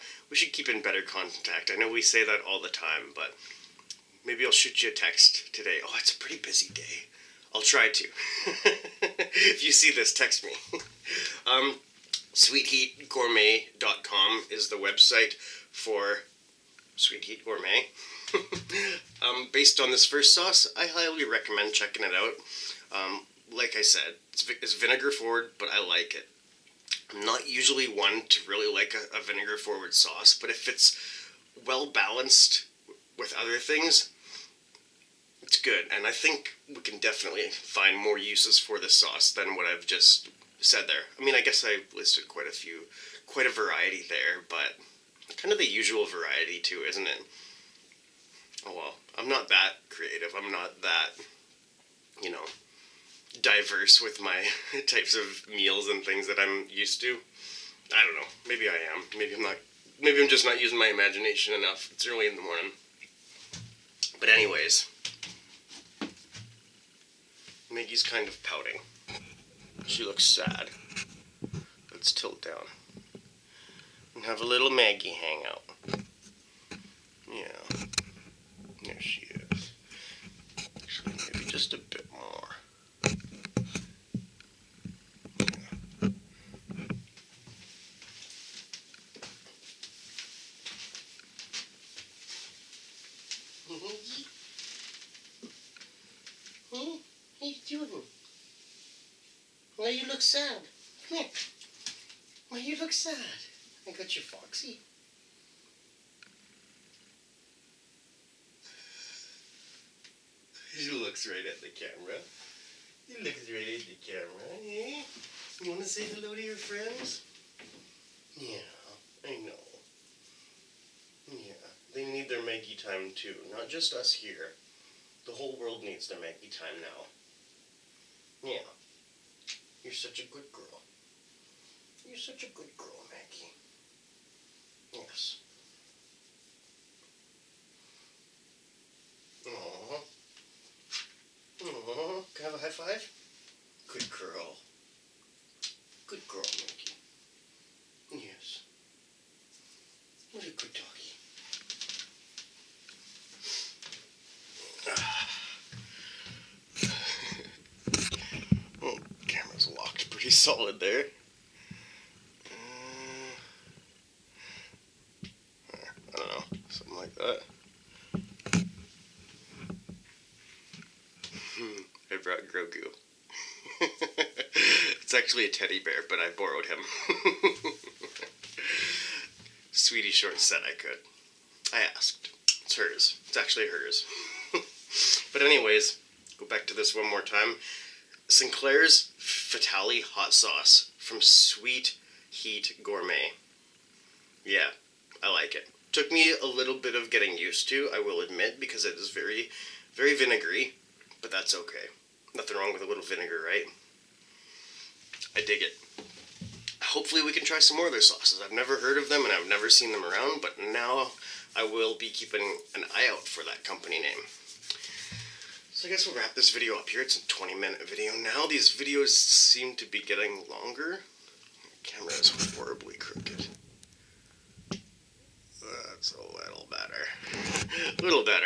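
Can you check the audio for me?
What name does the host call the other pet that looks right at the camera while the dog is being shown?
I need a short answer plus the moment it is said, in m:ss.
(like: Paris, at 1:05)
Foxy, at 1:44.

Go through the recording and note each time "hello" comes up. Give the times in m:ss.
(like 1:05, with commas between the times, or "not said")
1:56.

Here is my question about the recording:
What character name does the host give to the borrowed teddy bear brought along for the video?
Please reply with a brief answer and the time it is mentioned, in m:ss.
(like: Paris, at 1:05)
Grogu, at 2:52.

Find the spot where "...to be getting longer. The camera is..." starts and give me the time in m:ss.
3:39.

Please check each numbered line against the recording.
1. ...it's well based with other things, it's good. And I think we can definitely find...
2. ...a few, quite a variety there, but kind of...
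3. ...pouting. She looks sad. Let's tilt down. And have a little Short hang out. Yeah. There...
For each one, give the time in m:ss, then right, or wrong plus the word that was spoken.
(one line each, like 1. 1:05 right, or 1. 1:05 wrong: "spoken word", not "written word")
1. 0:30 wrong: "balanced", not "based"
2. 0:42 right
3. 1:08 wrong: "Maggie", not "Short".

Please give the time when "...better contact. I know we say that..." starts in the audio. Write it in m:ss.
0:00.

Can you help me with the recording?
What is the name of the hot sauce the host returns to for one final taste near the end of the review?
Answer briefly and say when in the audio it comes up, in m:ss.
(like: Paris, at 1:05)
Sinclair's Fatalii, at 3:08.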